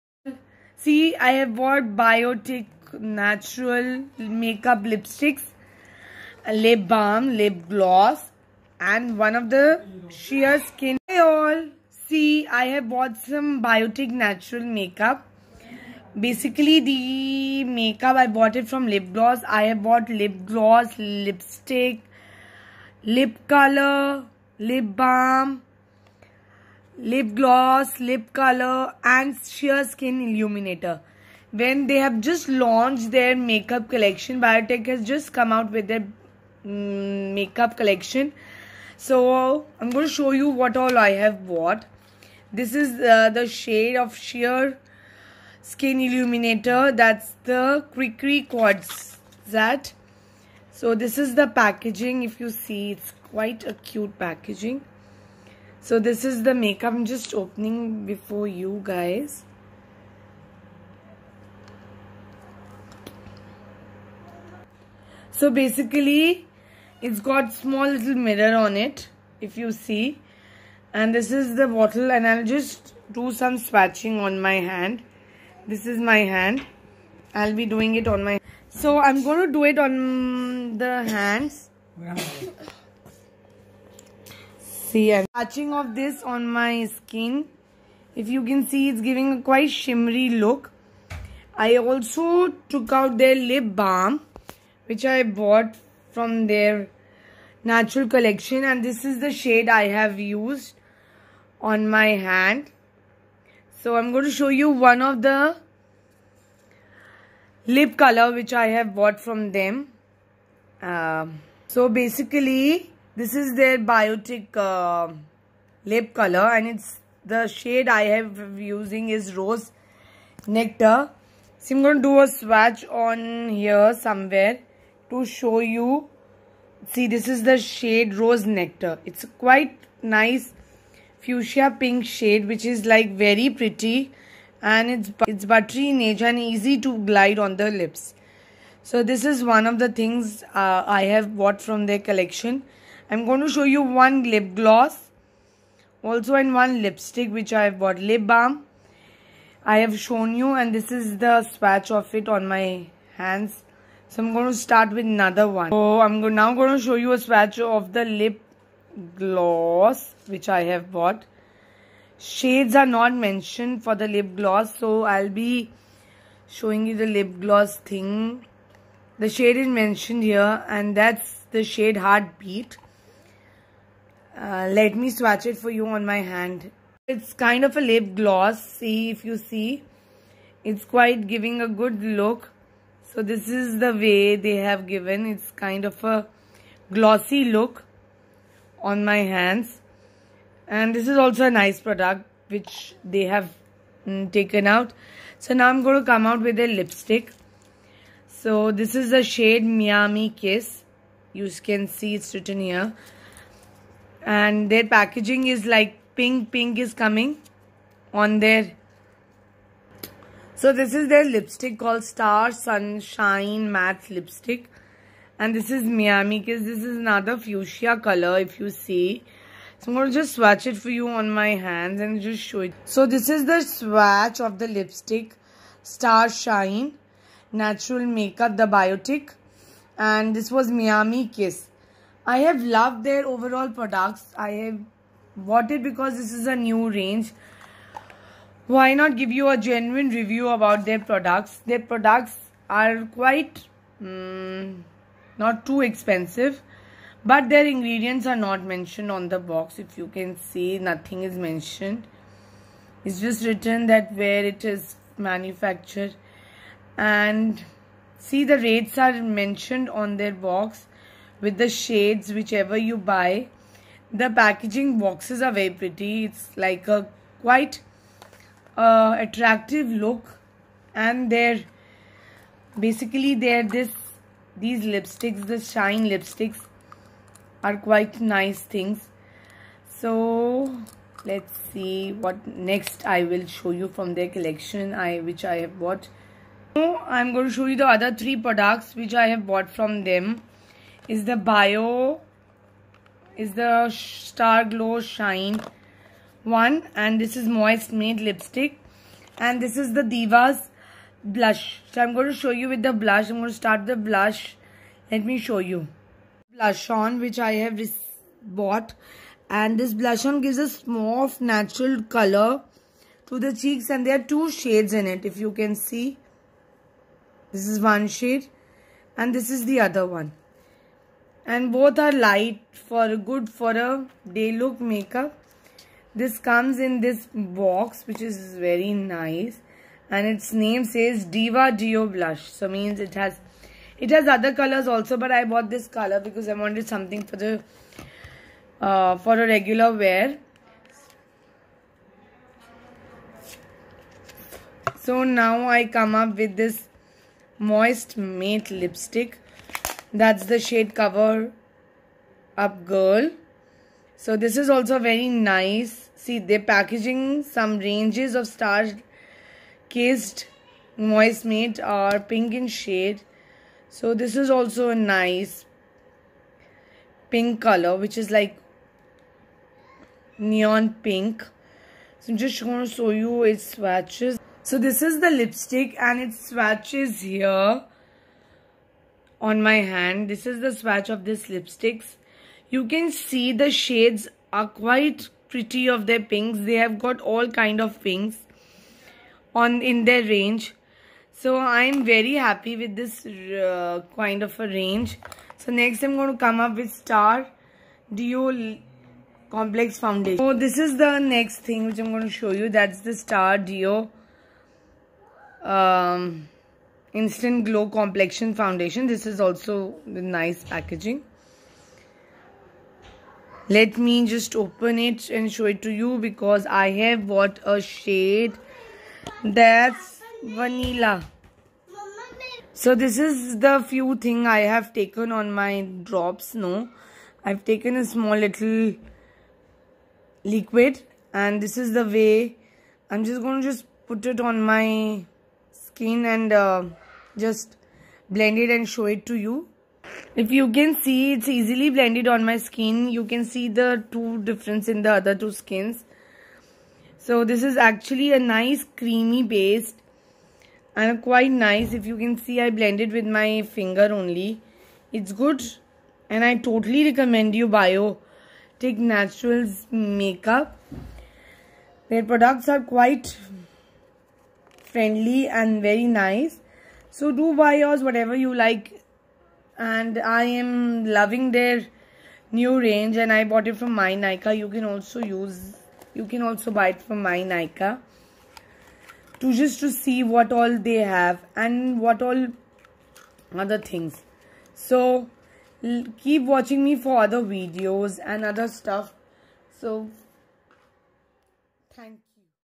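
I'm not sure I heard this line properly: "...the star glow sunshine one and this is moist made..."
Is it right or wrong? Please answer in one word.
wrong.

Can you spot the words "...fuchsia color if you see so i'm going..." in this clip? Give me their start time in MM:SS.
03:37.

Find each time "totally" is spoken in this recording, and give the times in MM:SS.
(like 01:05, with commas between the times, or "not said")
07:36.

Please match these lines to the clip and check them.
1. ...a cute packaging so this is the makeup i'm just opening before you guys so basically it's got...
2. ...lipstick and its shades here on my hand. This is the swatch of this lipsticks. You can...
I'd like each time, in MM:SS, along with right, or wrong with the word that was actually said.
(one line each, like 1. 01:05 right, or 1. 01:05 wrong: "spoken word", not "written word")
1. 00:53 right
2. 06:15 wrong: "swatches", not "shades".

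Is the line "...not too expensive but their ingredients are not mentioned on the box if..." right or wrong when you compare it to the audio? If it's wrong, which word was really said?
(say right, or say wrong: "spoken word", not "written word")
right.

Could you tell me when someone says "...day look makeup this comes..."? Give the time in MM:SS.
05:24.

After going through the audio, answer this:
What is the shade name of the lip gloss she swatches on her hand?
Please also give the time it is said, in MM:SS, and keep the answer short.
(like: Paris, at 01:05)
Heartbeat, at 02:51.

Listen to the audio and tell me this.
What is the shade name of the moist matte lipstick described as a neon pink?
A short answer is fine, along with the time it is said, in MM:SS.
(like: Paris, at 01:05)
Cover Up Girl, at 05:50.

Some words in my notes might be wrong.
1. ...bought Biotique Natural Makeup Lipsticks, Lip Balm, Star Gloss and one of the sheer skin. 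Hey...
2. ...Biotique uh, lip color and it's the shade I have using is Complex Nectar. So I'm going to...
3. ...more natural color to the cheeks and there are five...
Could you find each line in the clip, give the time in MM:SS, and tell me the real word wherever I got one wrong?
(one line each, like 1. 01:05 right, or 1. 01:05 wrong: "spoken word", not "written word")
1. 00:01 wrong: "Lip", not "Star"
2. 01:53 wrong: "Rose", not "Complex"
3. 05:10 wrong: "two", not "five".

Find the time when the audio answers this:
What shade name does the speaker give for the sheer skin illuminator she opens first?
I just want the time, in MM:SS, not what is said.
00:47.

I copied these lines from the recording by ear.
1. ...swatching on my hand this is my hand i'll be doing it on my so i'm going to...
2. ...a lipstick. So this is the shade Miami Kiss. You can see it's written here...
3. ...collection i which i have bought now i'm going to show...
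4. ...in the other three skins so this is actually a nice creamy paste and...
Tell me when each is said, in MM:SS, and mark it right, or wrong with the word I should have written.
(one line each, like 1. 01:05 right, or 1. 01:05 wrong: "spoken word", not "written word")
1. 01:13 right
2. 03:16 right
3. 04:44 right
4. 07:24 wrong: "two", not "three".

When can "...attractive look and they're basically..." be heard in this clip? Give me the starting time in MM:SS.
04:29.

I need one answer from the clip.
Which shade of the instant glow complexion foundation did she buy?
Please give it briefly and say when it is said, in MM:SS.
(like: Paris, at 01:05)
Vanilla, at 07:00.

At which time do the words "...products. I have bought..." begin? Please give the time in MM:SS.
03:53.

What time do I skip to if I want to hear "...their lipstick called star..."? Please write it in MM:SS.
03:31.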